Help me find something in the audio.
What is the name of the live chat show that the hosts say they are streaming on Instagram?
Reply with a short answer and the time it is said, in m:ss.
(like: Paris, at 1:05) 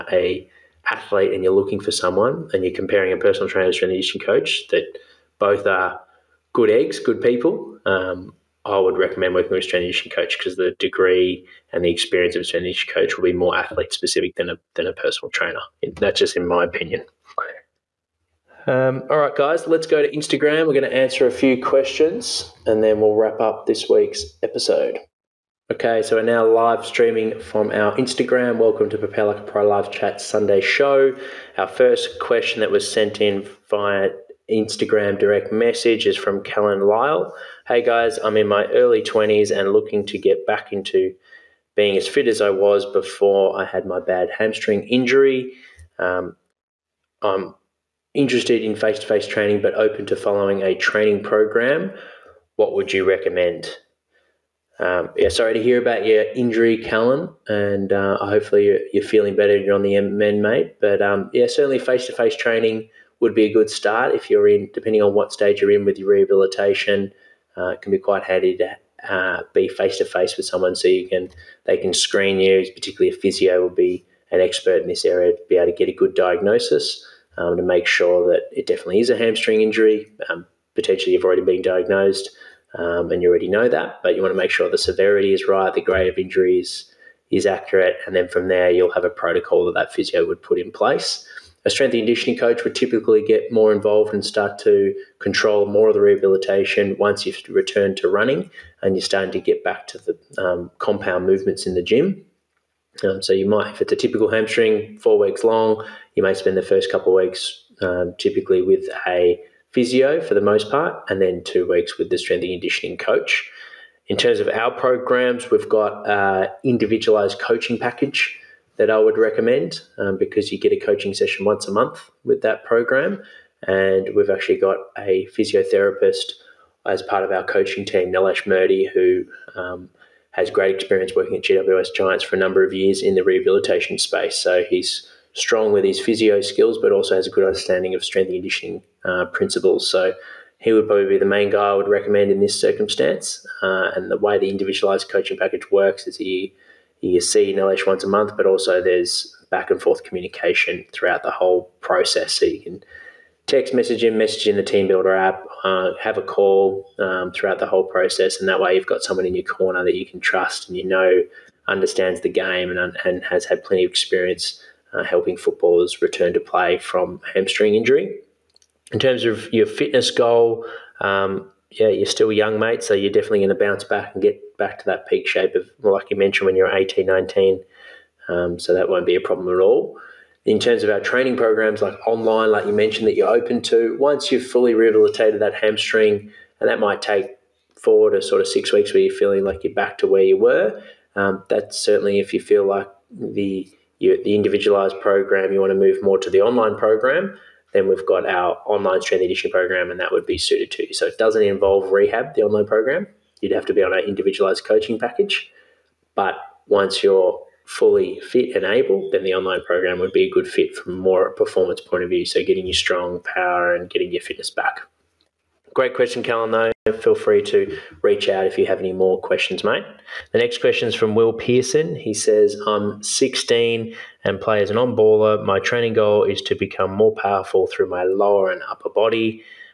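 Prepare Like a Pro, at 0:28.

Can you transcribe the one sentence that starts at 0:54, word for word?
Um, yeah, sorry to hear about your injury, Callum, and uh, hopefully you're, you're, feeling better.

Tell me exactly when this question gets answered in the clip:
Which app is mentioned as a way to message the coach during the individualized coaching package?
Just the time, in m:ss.
2:34.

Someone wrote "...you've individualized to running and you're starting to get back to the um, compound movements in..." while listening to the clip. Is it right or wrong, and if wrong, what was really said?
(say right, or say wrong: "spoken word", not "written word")
wrong: "returned", not "individualized".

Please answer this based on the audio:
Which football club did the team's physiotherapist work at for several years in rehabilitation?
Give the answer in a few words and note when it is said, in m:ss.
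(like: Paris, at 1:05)
GWS Giants, at 2:11.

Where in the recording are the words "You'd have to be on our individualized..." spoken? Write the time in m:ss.
3:23.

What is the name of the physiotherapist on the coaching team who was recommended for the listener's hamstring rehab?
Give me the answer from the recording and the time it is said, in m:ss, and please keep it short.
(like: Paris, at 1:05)
Nilesh Murdy, at 2:08.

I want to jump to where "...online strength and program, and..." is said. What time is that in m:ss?
3:18.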